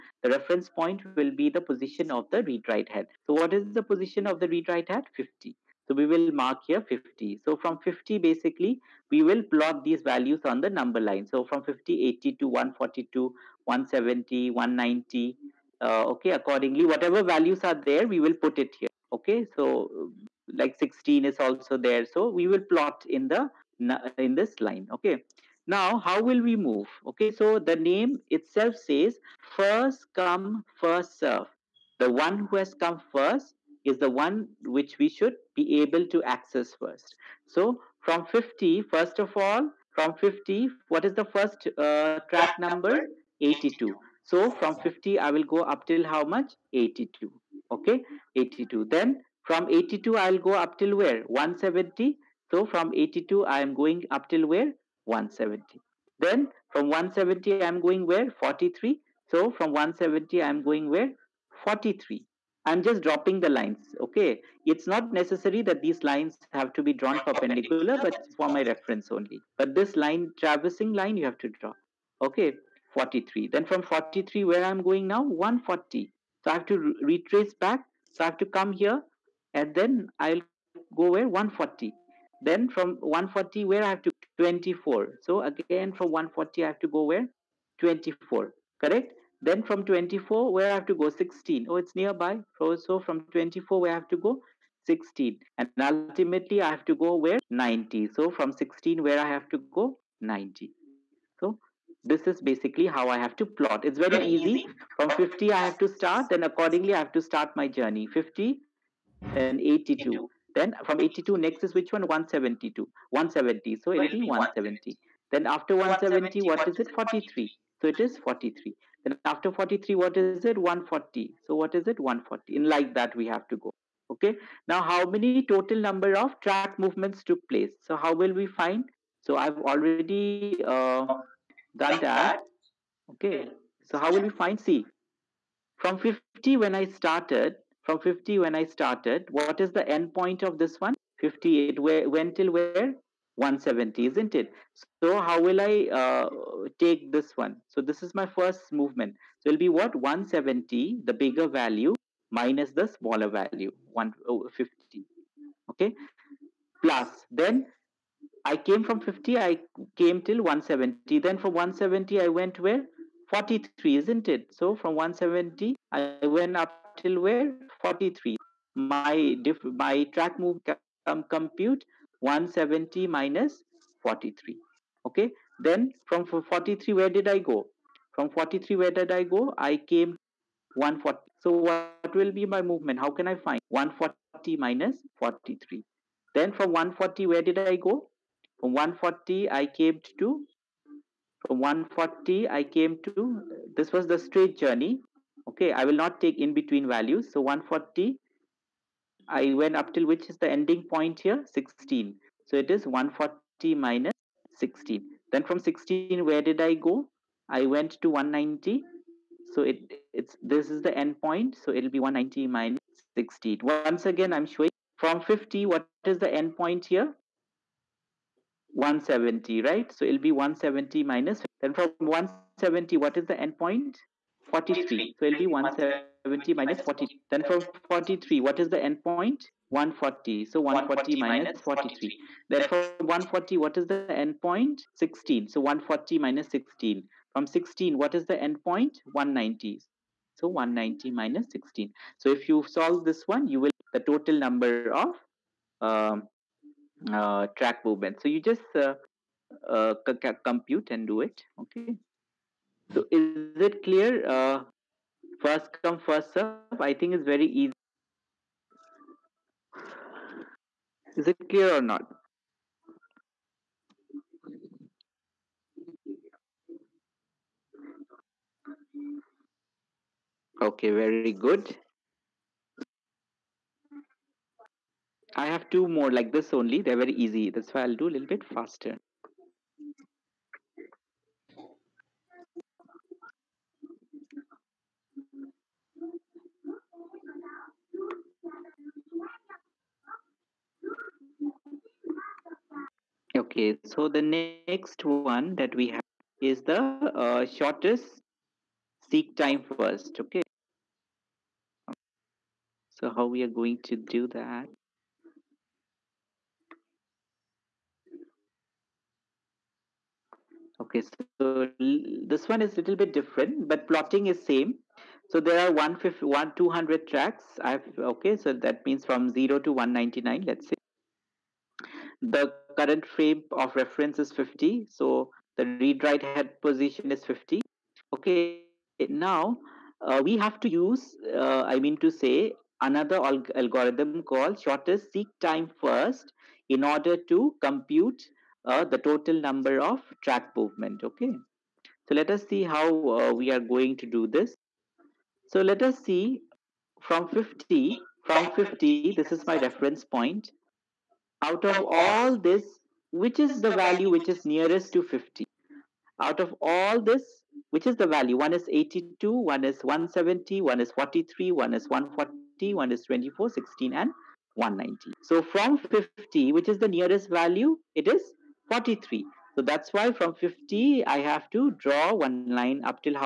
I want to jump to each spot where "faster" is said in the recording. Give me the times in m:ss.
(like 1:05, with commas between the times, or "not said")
4:38.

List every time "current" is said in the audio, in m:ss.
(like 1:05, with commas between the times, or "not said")
5:22.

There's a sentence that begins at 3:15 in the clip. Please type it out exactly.
Okay, I will not take in between values.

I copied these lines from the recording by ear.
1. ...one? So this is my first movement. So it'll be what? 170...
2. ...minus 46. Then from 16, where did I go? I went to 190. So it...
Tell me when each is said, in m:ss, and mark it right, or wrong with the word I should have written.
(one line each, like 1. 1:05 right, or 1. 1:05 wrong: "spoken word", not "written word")
1. 2:27 right
2. 3:23 wrong: "16", not "46".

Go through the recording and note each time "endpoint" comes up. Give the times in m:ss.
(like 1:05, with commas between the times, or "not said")
3:43, 3:48, 3:54, 3:58.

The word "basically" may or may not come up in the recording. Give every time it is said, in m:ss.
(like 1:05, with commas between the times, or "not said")
0:08, 1:42.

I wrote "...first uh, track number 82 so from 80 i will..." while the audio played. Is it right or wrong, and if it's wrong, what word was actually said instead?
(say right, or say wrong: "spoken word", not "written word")
wrong: "50", not "80".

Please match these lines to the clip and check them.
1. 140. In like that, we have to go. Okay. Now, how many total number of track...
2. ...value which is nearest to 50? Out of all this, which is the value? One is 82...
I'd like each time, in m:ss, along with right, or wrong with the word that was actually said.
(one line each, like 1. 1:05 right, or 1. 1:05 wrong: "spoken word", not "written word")
1. 2:01 right
2. 5:53 right.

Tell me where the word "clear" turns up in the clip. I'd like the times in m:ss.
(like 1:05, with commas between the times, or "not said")
4:13, 4:21.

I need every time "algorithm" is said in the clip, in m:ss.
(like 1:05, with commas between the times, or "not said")
5:33.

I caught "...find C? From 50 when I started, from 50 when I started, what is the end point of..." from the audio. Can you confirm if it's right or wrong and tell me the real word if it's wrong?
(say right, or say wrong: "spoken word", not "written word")
right.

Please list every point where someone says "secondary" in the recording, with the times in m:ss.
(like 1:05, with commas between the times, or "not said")
not said.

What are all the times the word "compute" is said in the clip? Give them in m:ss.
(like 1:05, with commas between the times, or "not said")
2:51, 4:10, 5:37.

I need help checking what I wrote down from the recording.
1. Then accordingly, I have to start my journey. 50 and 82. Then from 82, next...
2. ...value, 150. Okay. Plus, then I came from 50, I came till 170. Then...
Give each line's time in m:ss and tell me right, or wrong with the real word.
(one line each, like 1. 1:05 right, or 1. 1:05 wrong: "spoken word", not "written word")
1. 1:46 right
2. 2:33 right.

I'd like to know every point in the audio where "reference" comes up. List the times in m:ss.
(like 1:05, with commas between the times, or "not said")
0:00, 1:08, 5:23, 5:49.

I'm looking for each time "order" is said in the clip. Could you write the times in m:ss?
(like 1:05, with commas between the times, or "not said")
5:36.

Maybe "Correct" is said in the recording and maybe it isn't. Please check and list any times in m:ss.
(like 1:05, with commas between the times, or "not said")
1:28.